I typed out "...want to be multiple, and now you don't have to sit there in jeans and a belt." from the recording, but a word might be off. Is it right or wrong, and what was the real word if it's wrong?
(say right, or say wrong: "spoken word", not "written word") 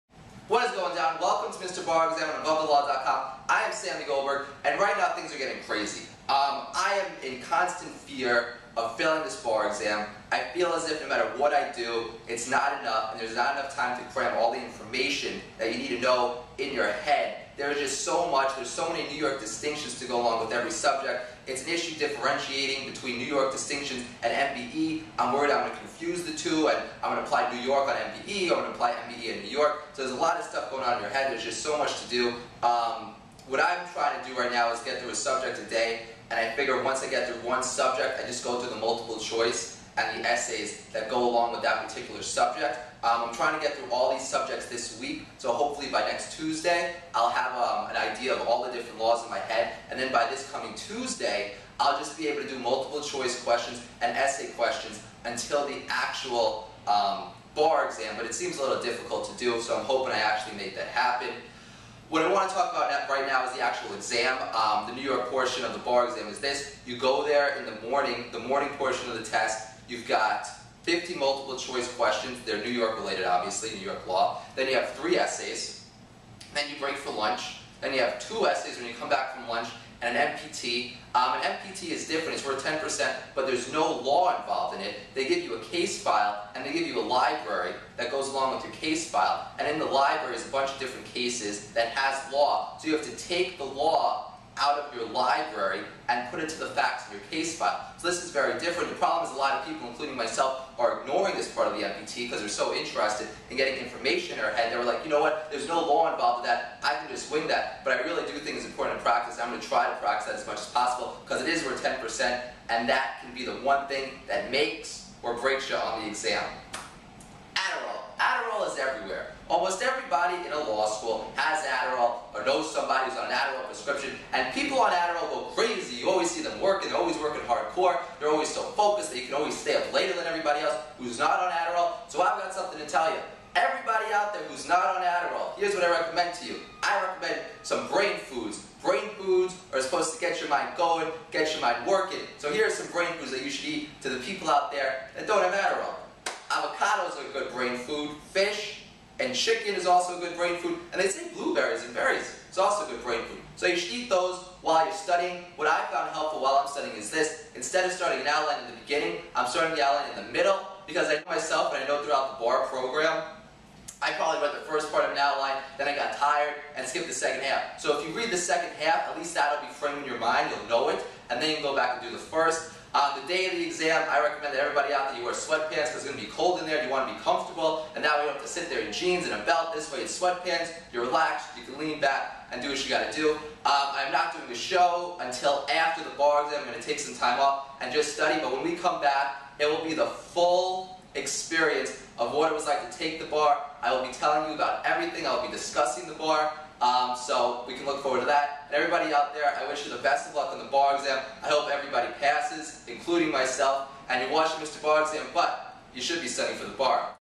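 wrong: "comfortable", not "multiple".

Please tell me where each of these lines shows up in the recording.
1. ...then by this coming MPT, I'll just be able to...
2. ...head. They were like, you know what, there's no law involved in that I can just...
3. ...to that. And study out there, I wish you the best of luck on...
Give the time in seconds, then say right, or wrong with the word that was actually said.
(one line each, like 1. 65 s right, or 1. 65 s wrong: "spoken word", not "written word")
1. 49 s wrong: "Tuesday", not "MPT"
2. 104 s right
3. 198 s wrong: "everybody", not "study".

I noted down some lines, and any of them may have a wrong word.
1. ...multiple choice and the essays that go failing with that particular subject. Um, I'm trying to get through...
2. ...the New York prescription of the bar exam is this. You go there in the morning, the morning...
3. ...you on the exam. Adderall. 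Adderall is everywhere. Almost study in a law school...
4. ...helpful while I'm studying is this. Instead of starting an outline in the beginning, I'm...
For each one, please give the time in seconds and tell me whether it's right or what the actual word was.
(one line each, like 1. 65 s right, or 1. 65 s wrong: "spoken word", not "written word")
1. 38 s wrong: "along", not "failing"
2. 64 s wrong: "portion", not "prescription"
3. 115 s wrong: "everybody", not "study"
4. 156 s right.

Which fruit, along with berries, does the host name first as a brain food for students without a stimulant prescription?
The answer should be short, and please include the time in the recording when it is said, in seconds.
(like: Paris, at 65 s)
Avocados, at 146 s.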